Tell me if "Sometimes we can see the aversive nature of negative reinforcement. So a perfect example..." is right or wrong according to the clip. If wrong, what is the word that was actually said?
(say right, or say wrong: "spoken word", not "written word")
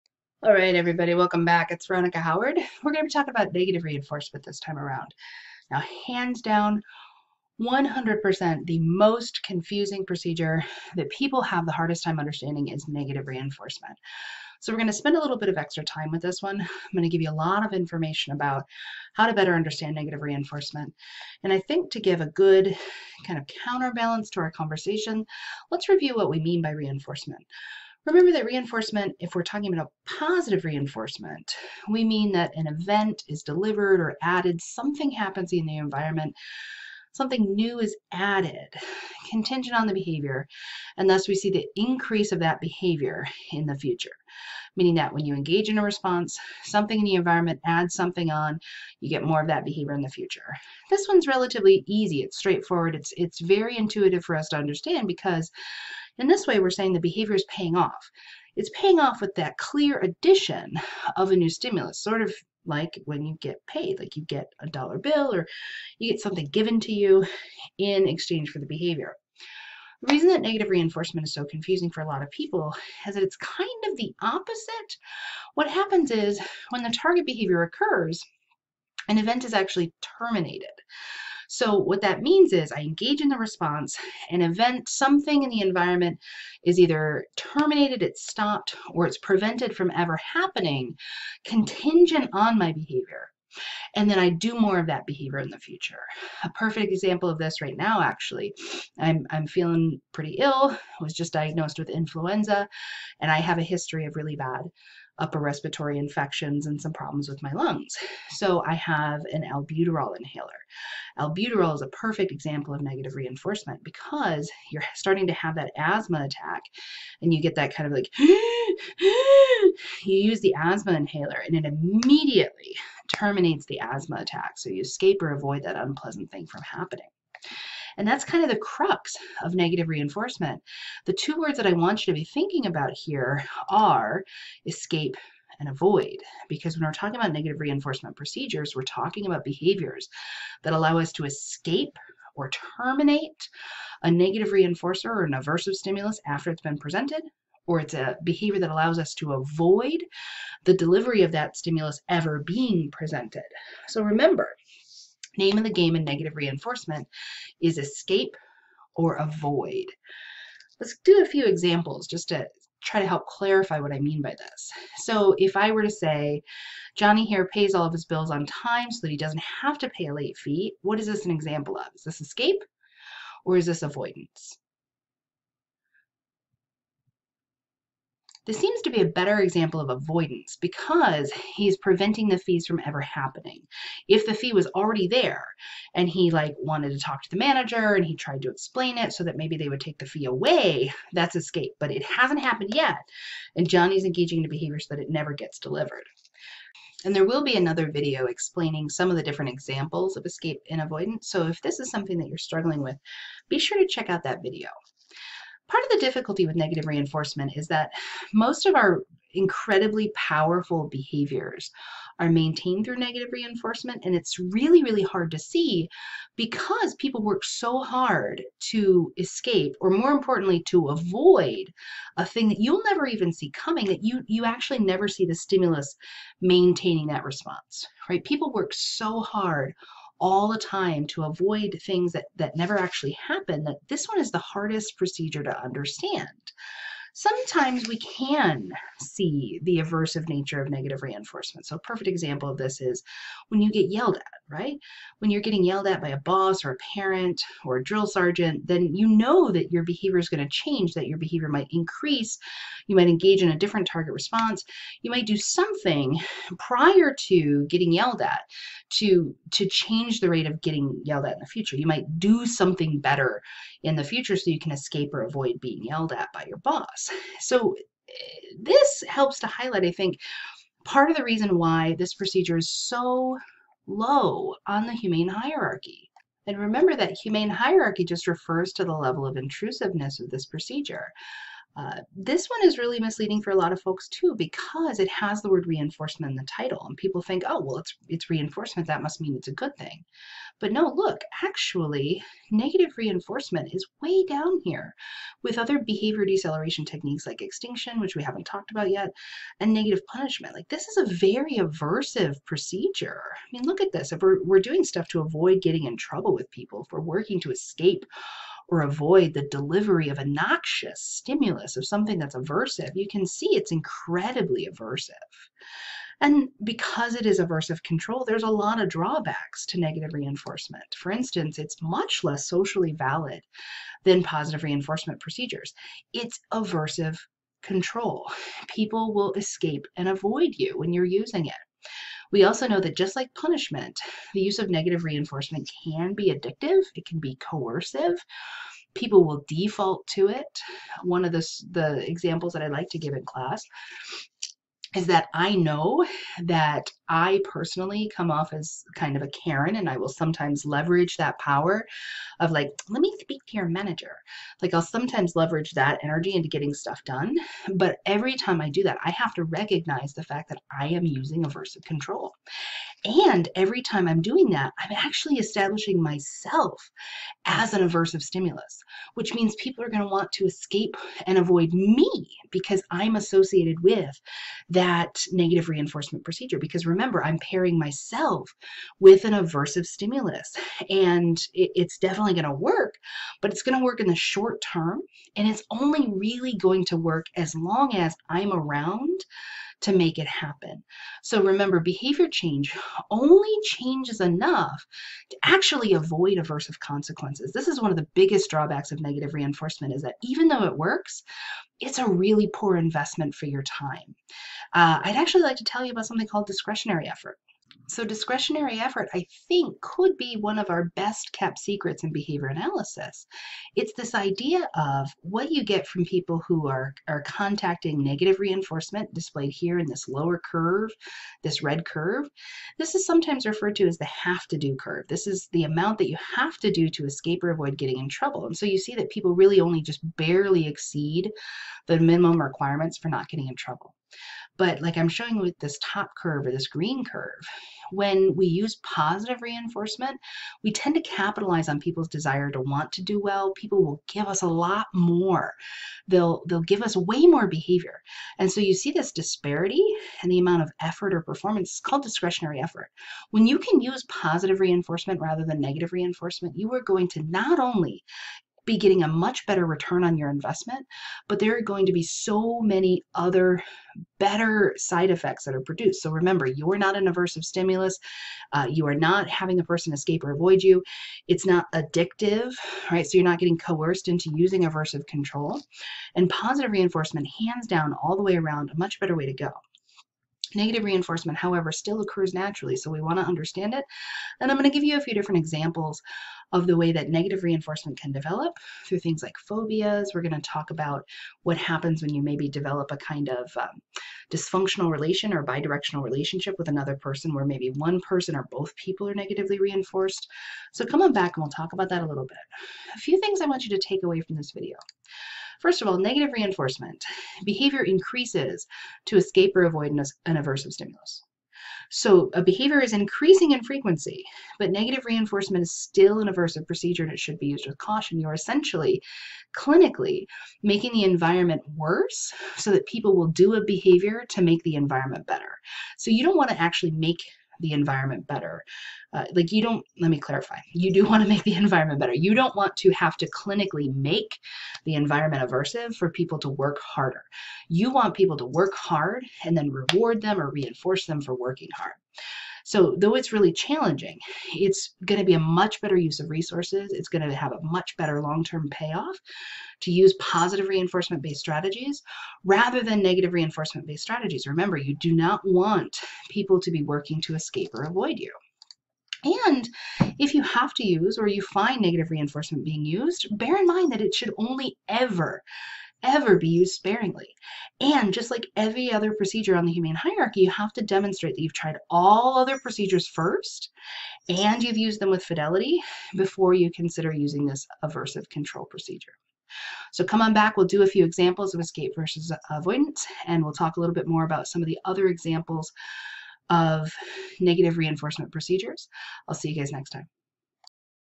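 right.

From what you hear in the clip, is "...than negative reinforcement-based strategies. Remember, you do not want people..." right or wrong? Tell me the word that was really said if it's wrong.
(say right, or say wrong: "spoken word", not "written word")
right.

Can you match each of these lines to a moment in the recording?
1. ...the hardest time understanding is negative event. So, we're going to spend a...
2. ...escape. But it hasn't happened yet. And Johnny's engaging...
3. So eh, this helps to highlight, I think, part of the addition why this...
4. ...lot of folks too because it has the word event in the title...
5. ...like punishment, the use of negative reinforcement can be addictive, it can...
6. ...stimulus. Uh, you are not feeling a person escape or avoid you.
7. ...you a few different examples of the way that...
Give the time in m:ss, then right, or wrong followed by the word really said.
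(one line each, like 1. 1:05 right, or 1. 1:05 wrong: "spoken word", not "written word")
1. 0:11 wrong: "reinforcement", not "event"
2. 3:11 right
3. 4:27 wrong: "reason", not "addition"
4. 4:43 wrong: "reinforcement", not "event"
5. 5:33 right
6. 7:47 wrong: "having", not "feeling"
7. 8:04 right.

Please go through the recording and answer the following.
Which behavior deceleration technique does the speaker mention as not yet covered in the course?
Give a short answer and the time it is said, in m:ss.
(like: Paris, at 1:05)
Extinction, at 4:57.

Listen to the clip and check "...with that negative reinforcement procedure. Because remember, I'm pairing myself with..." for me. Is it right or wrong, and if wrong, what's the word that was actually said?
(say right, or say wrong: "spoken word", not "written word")
right.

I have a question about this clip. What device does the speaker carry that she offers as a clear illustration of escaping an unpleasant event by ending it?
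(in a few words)
Albuterol inhaler.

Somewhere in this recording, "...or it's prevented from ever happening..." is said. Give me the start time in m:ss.
1:28.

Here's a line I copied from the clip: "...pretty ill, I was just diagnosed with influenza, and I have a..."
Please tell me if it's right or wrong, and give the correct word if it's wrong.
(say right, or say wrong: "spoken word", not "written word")
right.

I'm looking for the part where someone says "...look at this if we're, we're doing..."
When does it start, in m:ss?
5:03.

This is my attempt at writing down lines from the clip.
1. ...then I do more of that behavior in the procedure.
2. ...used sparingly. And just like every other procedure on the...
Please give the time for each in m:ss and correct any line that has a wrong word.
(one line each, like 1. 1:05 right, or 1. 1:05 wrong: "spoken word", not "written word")
1. 1:34 wrong: "future", not "procedure"
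2. 9:26 right.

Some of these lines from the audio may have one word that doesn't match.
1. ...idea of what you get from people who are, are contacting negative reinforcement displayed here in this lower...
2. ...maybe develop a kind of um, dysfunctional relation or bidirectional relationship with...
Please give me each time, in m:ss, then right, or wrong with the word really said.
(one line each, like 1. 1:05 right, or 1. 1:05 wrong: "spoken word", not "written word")
1. 6:54 right
2. 8:12 right.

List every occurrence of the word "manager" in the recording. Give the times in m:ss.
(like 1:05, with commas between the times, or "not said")
3:07, 5:53.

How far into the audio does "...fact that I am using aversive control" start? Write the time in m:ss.
6:00.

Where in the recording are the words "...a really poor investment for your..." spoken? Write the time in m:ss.
6:41.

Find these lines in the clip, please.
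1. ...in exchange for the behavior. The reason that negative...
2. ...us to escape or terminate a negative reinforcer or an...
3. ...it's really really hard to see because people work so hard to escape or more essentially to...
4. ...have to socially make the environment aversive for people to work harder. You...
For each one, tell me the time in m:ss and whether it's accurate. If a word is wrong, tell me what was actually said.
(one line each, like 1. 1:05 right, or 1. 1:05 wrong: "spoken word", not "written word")
1. 1:07 right
2. 2:20 right
3. 3:34 wrong: "importantly", not "essentially"
4. 8:52 wrong: "clinically", not "socially".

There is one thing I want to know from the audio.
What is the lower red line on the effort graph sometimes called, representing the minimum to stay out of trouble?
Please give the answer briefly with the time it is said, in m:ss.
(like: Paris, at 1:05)
Have to do curve, at 7:04.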